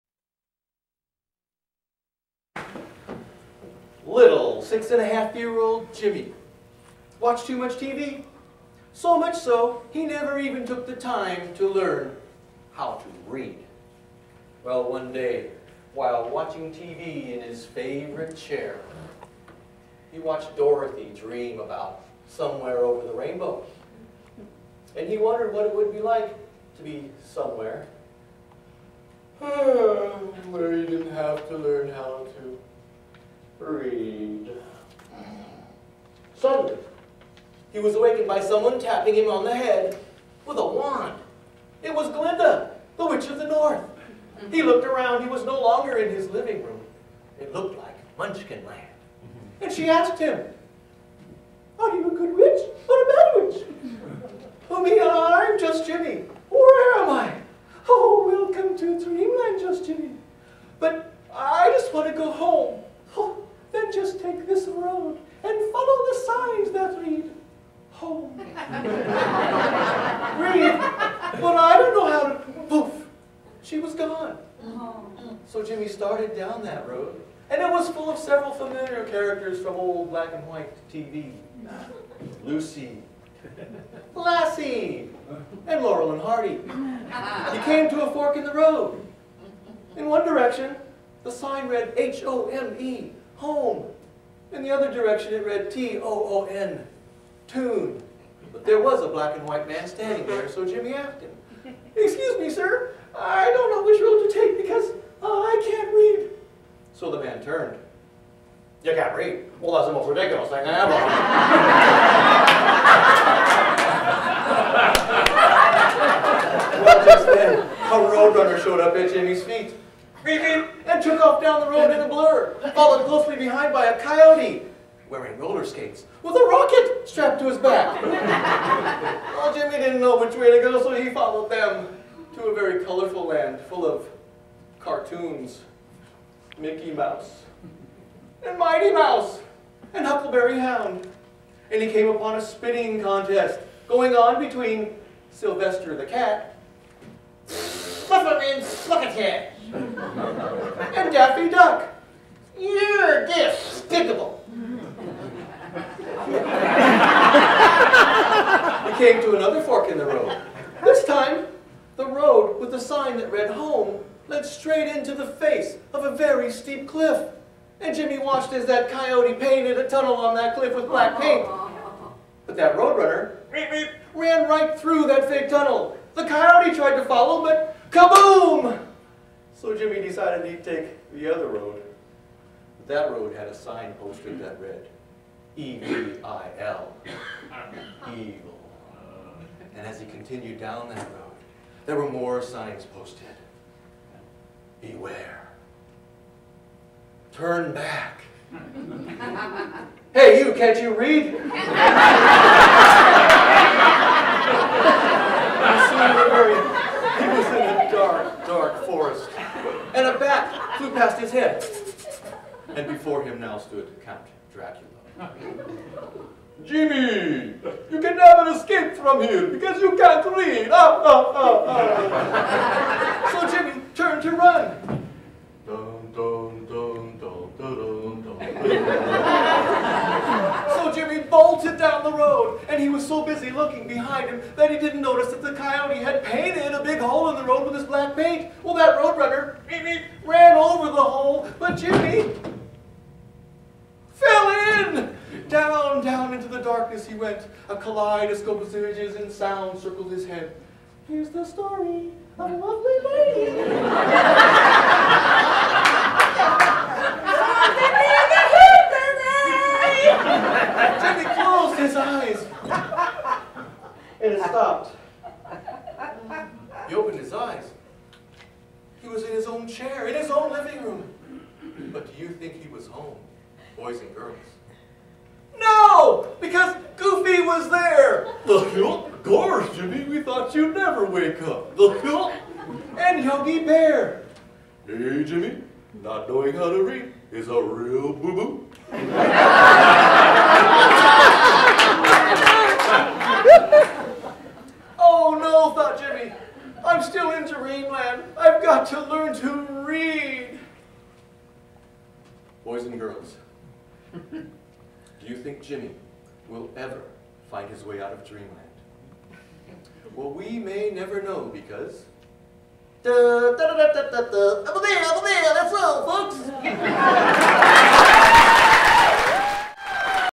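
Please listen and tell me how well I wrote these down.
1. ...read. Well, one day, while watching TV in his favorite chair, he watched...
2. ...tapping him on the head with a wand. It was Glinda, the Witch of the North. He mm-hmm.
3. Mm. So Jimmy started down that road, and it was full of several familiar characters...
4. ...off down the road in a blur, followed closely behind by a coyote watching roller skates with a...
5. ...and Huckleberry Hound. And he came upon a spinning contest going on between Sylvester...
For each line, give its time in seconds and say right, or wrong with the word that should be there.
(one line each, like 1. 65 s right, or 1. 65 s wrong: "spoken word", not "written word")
1. 13 s right
2. 38 s right
3. 75 s right
4. 121 s wrong: "wearing", not "watching"
5. 139 s right.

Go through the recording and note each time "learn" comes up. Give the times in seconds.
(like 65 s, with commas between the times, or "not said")
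11 s, 31 s, 299 s.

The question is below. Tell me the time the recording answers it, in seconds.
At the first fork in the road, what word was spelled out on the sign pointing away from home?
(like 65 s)
95 s.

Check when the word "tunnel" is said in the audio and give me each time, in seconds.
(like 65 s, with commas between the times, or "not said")
169 s, 175 s.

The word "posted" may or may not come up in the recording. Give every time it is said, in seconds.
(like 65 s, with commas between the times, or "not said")
183 s, 192 s.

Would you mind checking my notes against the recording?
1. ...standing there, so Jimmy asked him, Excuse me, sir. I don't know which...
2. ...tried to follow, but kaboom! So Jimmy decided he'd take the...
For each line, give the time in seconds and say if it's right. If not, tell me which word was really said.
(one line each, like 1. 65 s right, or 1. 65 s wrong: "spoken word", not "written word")
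1. 99 s right
2. 176 s right.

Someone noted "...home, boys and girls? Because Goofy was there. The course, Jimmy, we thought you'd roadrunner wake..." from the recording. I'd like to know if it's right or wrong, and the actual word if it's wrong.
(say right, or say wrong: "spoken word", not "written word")
wrong: "never", not "roadrunner".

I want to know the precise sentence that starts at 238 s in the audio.
Well, that roadrunner ran over the hole, but Jimmy Down into the darkness he went.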